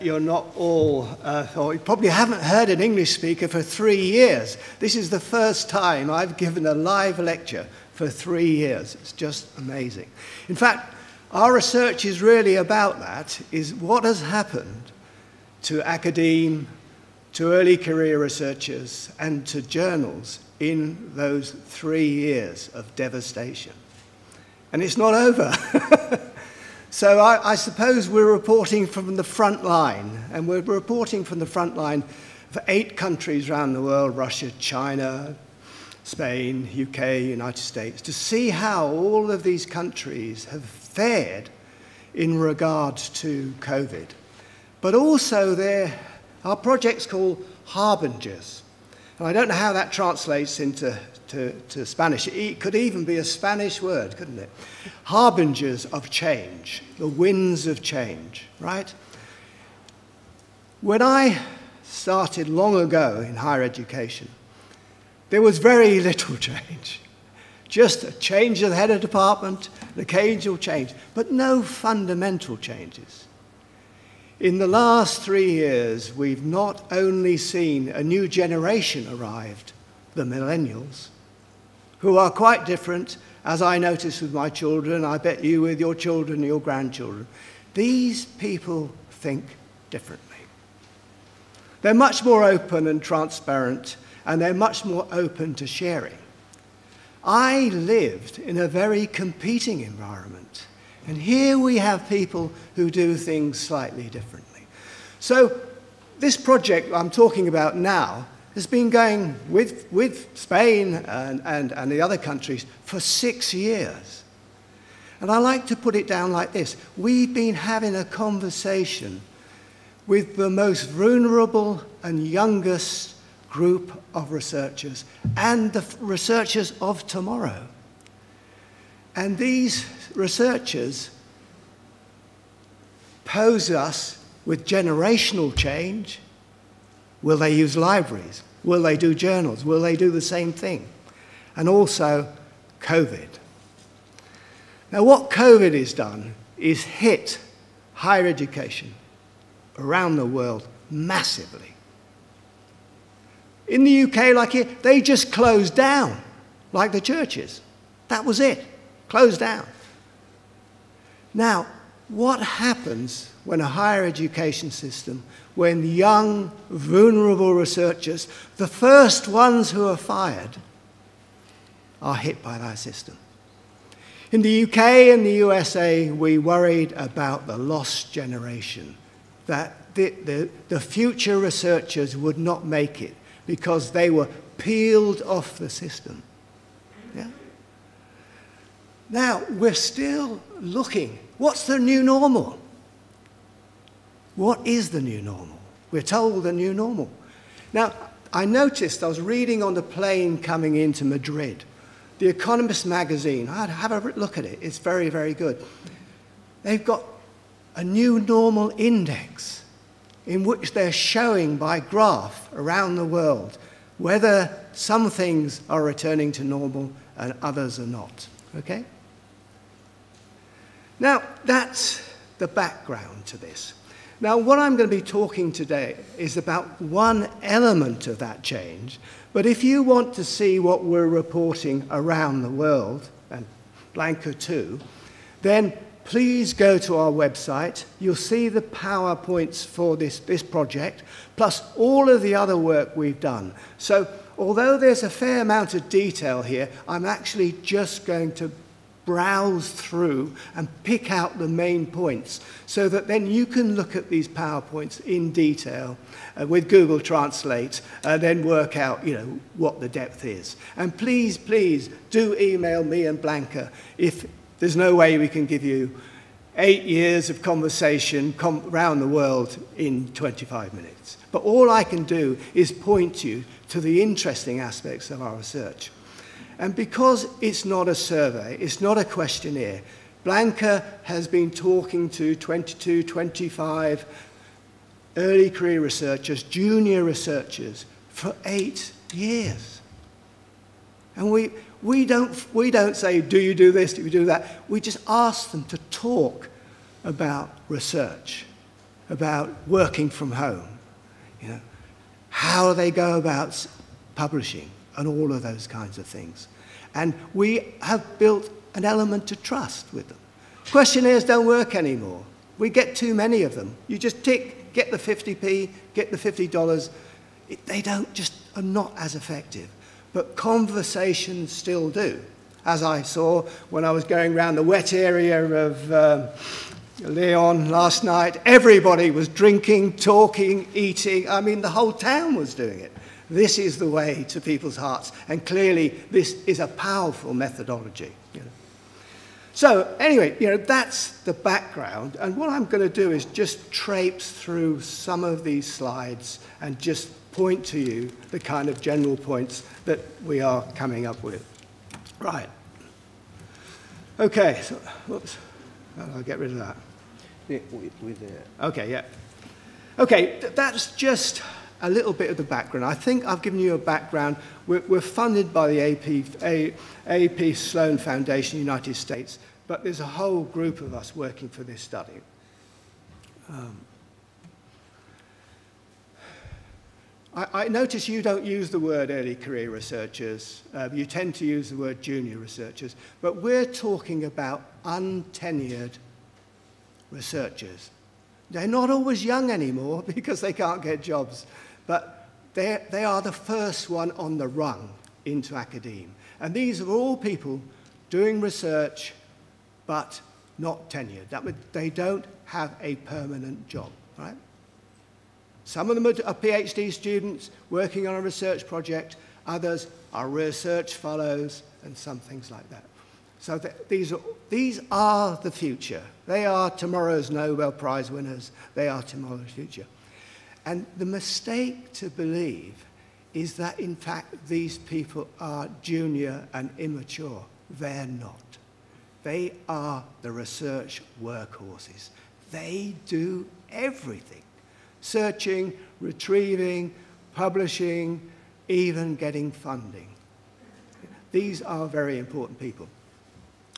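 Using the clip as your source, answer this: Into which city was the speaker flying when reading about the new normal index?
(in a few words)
Madrid.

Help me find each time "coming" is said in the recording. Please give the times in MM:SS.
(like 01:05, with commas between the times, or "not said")
03:20, 05:50.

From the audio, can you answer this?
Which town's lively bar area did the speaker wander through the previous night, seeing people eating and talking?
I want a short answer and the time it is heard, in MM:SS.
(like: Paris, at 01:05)
Leon, at 05:27.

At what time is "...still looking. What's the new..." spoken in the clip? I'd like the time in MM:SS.
03:09.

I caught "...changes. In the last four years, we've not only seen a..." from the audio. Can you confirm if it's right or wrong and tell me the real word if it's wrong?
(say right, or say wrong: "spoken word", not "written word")
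wrong: "three", not "four".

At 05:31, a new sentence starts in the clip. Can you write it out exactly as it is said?
I mean, the whole town was doing it.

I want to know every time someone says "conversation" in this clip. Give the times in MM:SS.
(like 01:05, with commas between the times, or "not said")
01:58, 04:27, 05:20.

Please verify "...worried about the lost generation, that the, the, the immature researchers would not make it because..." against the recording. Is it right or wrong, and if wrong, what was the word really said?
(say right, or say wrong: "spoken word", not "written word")
wrong: "future", not "immature".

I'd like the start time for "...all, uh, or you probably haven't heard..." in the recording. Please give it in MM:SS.
00:00.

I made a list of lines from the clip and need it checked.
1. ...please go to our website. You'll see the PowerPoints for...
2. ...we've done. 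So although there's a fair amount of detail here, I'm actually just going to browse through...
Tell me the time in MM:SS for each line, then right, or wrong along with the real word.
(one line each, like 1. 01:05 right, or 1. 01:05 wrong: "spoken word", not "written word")
1. 03:56 right
2. 04:02 right.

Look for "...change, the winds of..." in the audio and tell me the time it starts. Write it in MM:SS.
00:56.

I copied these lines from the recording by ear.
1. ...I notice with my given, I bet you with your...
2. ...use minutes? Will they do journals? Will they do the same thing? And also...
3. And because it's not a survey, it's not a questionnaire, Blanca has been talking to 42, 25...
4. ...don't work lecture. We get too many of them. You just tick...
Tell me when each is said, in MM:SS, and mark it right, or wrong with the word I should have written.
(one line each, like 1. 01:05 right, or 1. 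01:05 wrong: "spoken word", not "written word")
1. 01:23 wrong: "children", not "given"
2. 02:17 wrong: "libraries", not "minutes"
3. 04:36 wrong: "22", not "42"
4. 05:11 wrong: "anymore", not "lecture".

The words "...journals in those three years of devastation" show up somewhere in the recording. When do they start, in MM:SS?
00:19.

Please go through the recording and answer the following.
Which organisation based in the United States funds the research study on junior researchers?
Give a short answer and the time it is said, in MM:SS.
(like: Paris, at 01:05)
Sloan Foundation, at 06:07.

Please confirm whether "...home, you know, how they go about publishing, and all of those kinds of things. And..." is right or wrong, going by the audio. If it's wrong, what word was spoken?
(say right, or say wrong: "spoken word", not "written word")
right.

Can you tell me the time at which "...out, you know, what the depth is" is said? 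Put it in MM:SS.
04:18.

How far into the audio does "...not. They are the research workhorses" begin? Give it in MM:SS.
07:08.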